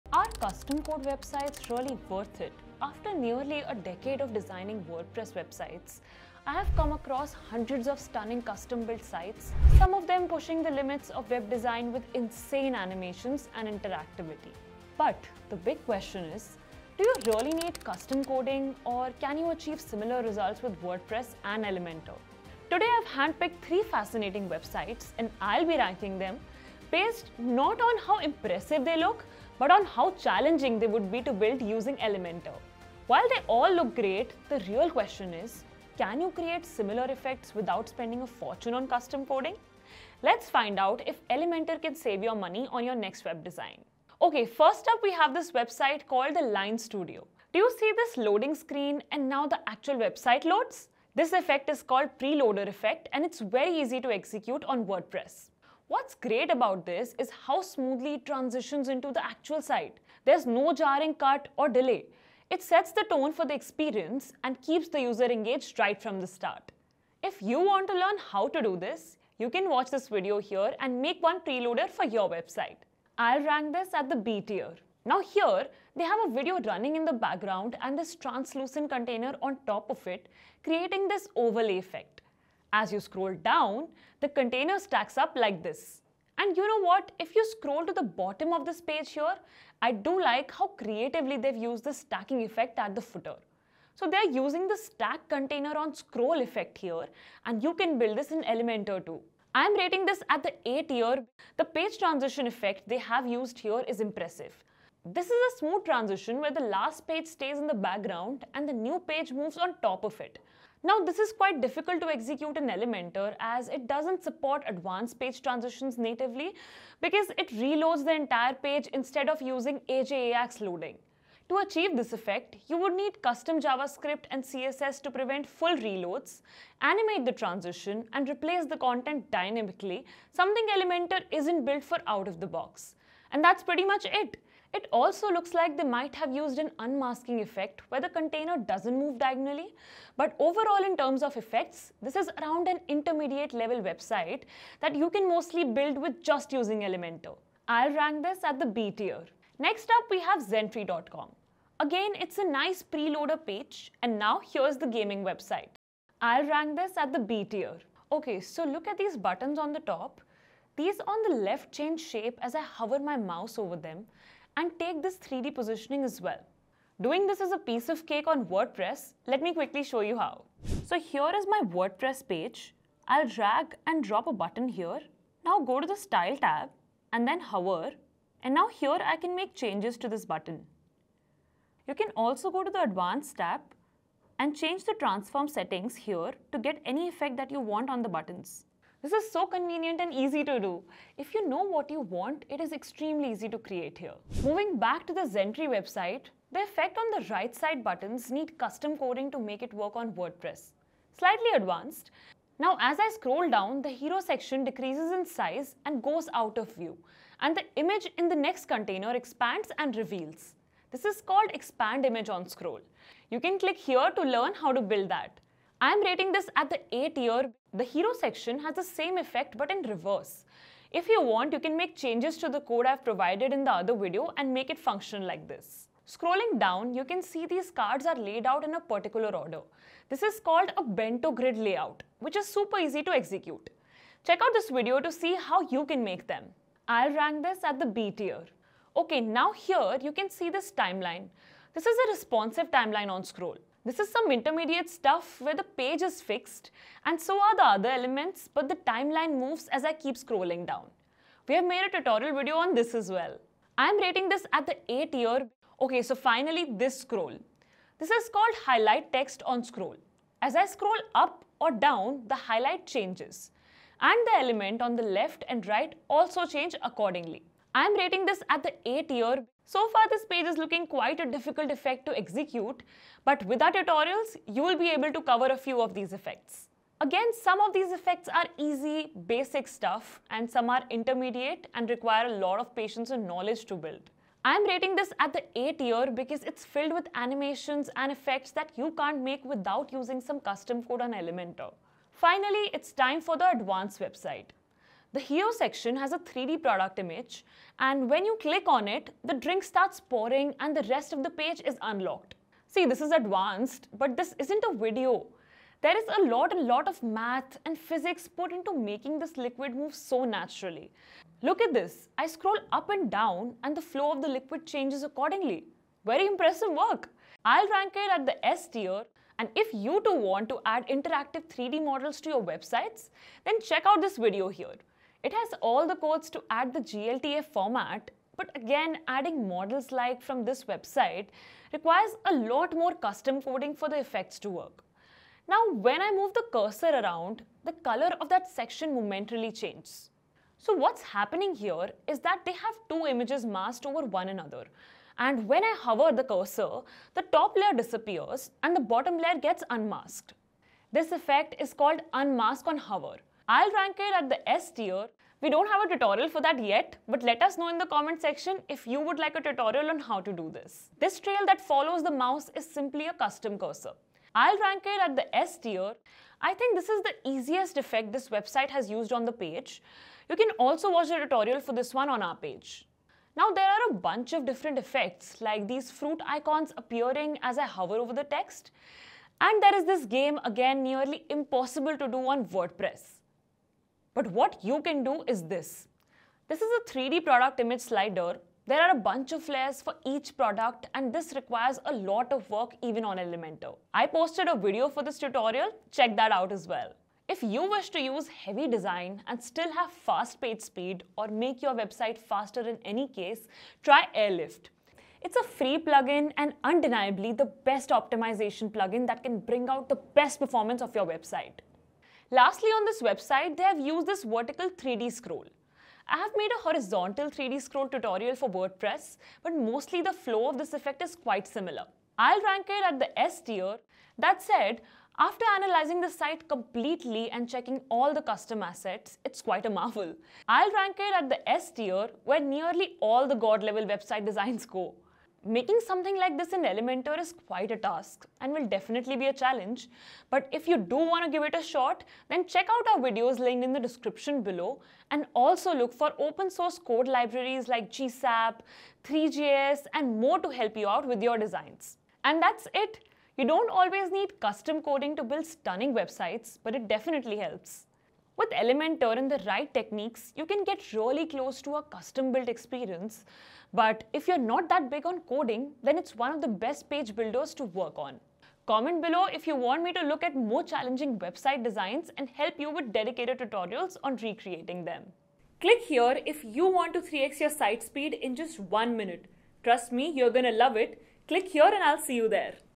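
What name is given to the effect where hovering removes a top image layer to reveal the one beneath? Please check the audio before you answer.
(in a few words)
unmask on hover.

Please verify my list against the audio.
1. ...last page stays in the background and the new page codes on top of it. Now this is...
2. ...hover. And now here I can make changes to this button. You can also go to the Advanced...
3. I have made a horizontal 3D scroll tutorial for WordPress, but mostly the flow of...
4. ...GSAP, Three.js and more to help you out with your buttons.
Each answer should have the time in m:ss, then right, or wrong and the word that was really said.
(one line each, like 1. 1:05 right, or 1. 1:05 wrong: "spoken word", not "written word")
1. 1:46 wrong: "moves", not "codes"
2. 2:57 right
3. 6:56 right
4. 7:27 wrong: "designs", not "buttons".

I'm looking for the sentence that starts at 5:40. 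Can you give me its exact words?
So what's happening here is that they have two images masked over one another.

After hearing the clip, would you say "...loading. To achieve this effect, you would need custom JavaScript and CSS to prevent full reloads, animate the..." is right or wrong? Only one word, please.
right.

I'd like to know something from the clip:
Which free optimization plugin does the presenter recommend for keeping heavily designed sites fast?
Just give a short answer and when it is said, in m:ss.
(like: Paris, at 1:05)
Airlift, at 6:44.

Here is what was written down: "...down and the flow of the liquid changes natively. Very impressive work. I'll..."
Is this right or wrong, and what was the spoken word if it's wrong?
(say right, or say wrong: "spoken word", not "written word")
wrong: "accordingly", not "natively".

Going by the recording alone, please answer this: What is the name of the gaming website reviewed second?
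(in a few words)
Zentry.com.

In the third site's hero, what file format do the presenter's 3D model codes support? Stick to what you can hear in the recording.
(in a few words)
GLTF.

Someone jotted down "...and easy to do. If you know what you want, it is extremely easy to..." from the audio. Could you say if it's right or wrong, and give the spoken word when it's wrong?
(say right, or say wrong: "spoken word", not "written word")
right.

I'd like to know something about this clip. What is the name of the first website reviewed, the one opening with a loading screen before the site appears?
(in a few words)
the Line Studio.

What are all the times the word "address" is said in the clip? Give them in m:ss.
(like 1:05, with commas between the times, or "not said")
not said.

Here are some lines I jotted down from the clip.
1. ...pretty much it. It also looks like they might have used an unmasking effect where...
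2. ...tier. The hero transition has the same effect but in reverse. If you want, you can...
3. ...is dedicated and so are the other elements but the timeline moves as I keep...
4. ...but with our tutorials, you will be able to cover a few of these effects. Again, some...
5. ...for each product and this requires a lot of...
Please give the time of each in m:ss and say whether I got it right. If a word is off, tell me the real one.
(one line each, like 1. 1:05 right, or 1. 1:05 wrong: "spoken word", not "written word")
1. 2:13 right
2. 3:37 wrong: "section", not "transition"
3. 4:06 wrong: "fixed", not "dedicated"
4. 4:33 right
5. 6:29 right.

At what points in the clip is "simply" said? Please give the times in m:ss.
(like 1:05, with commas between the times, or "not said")
6:02.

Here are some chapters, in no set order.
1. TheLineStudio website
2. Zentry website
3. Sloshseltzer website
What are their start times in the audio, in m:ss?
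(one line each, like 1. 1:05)
1. 0:44
2. 2:29
3. 4:51.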